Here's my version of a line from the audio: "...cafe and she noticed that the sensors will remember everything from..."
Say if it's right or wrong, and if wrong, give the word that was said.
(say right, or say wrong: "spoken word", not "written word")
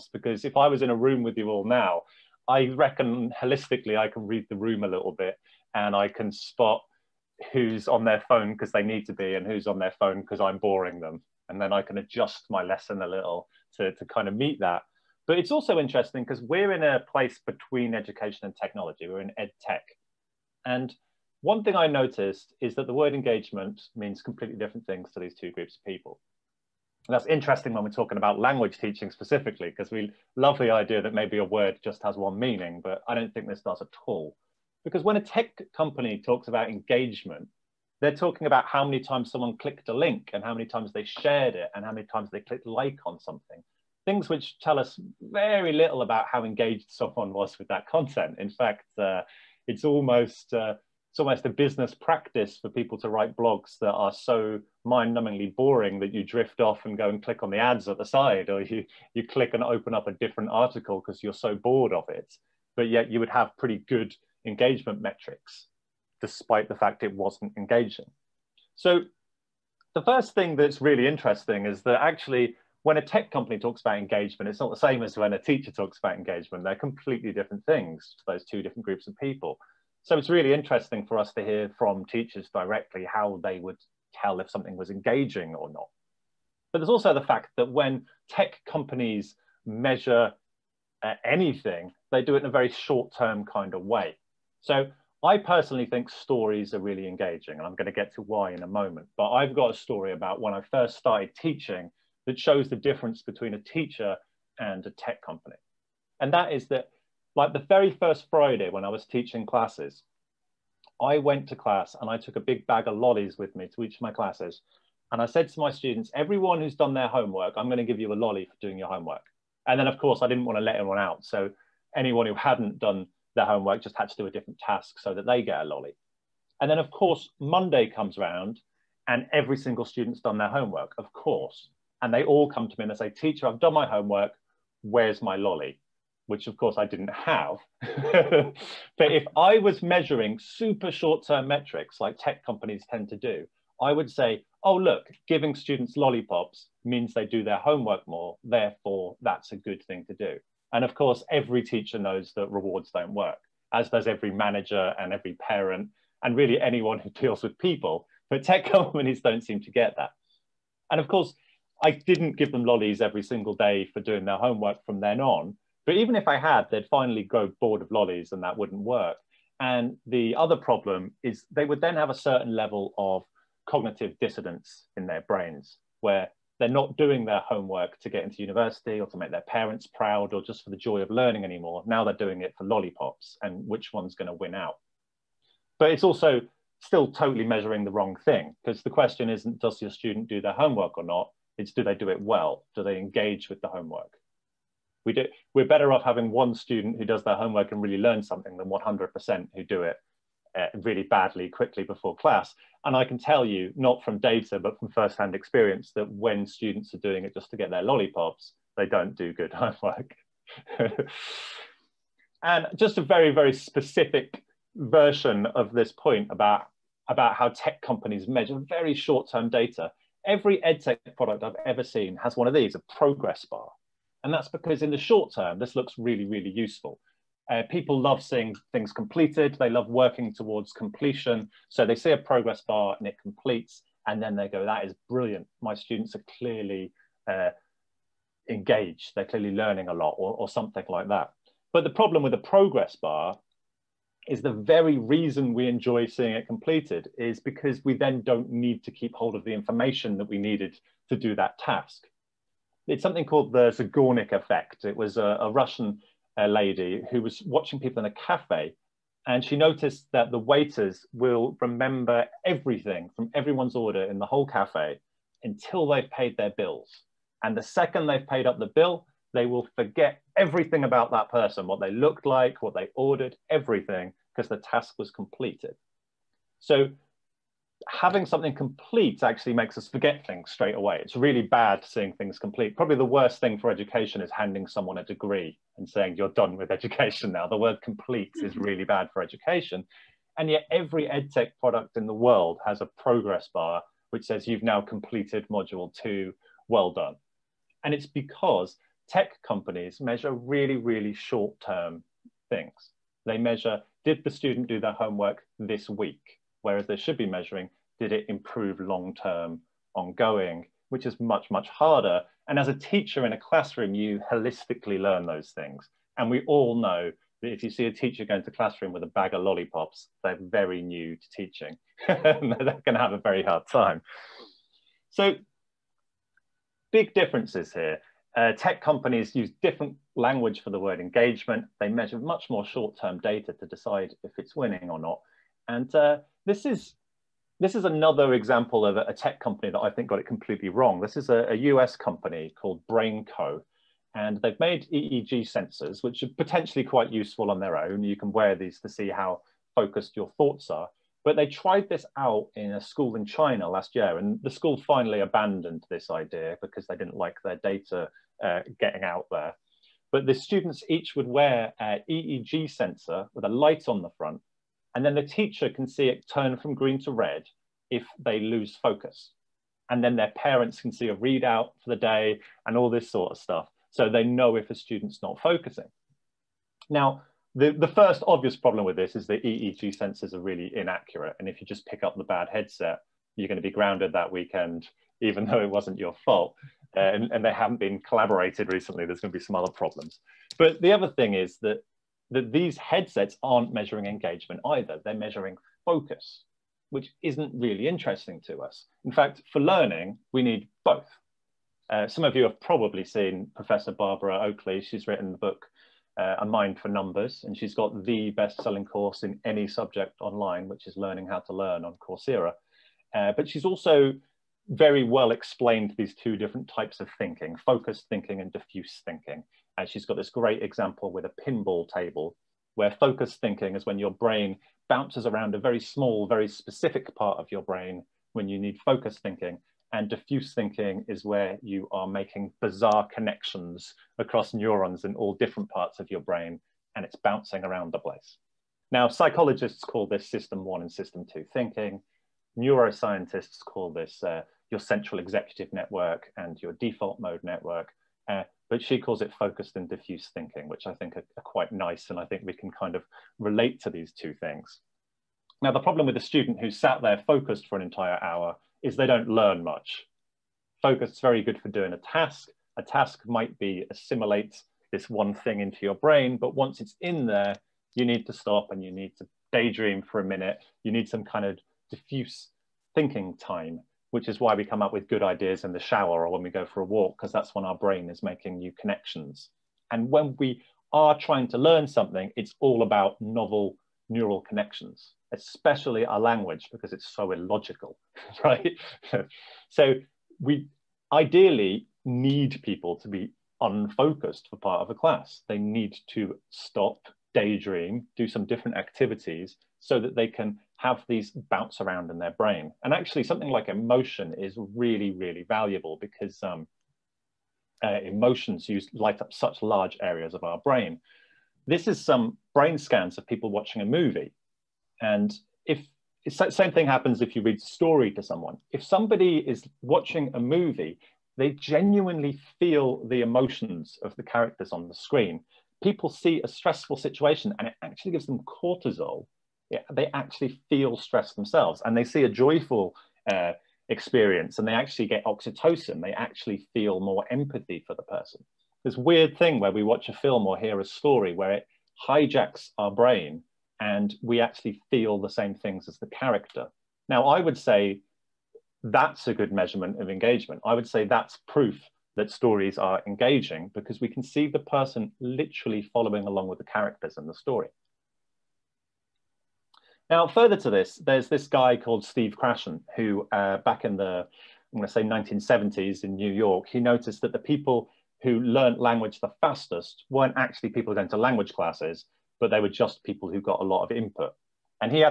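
wrong: "waiters", not "sensors".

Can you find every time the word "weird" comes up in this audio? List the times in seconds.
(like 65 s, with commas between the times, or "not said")
538 s.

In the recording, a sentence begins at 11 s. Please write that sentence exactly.
And then I can adjust my lesson a little to, to kind of meet that.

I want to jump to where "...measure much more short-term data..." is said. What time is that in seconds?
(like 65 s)
331 s.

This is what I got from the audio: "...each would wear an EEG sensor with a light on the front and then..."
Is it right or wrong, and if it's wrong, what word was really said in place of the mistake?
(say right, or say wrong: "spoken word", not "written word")
right.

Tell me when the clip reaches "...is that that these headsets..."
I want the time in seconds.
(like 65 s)
391 s.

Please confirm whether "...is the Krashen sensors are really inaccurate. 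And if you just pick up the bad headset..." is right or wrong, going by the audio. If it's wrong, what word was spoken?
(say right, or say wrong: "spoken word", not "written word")
wrong: "EEG", not "Krashen".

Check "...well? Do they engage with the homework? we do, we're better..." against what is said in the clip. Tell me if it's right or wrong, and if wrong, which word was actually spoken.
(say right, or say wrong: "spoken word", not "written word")
right.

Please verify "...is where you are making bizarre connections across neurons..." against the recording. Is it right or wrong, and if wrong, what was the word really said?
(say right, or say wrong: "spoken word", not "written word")
right.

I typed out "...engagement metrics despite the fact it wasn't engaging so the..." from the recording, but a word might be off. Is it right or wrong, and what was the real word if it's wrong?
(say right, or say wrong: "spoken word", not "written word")
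right.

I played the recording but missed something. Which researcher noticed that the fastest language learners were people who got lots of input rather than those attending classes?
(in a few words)
Steve Krashen.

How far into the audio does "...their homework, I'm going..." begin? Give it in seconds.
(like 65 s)
116 s.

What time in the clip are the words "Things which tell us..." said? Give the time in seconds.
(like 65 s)
44 s.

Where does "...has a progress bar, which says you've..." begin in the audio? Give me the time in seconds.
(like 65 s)
292 s.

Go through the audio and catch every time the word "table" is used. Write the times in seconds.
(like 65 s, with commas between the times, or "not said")
421 s.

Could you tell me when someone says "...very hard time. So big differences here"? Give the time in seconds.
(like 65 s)
323 s.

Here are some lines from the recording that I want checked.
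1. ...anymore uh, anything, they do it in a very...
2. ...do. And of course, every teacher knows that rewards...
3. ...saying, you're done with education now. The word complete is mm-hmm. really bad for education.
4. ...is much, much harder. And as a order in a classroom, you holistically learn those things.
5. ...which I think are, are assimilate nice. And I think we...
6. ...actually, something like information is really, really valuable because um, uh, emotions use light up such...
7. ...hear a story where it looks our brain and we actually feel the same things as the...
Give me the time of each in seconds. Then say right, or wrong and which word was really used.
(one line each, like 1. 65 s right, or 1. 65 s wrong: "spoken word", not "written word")
1. 89 s wrong: "measure", not "anymore"
2. 150 s right
3. 285 s right
4. 311 s wrong: "teacher", not "order"
5. 450 s wrong: "quite", not "assimilate"
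6. 502 s wrong: "emotion", not "information"
7. 540 s wrong: "hijacks", not "looks".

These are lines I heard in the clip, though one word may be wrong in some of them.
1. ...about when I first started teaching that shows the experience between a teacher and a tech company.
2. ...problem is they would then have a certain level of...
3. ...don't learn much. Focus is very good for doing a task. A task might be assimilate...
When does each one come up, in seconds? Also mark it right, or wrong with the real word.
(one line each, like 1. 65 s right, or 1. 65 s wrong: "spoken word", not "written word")
1. 100 s wrong: "difference", not "experience"
2. 170 s right
3. 459 s right.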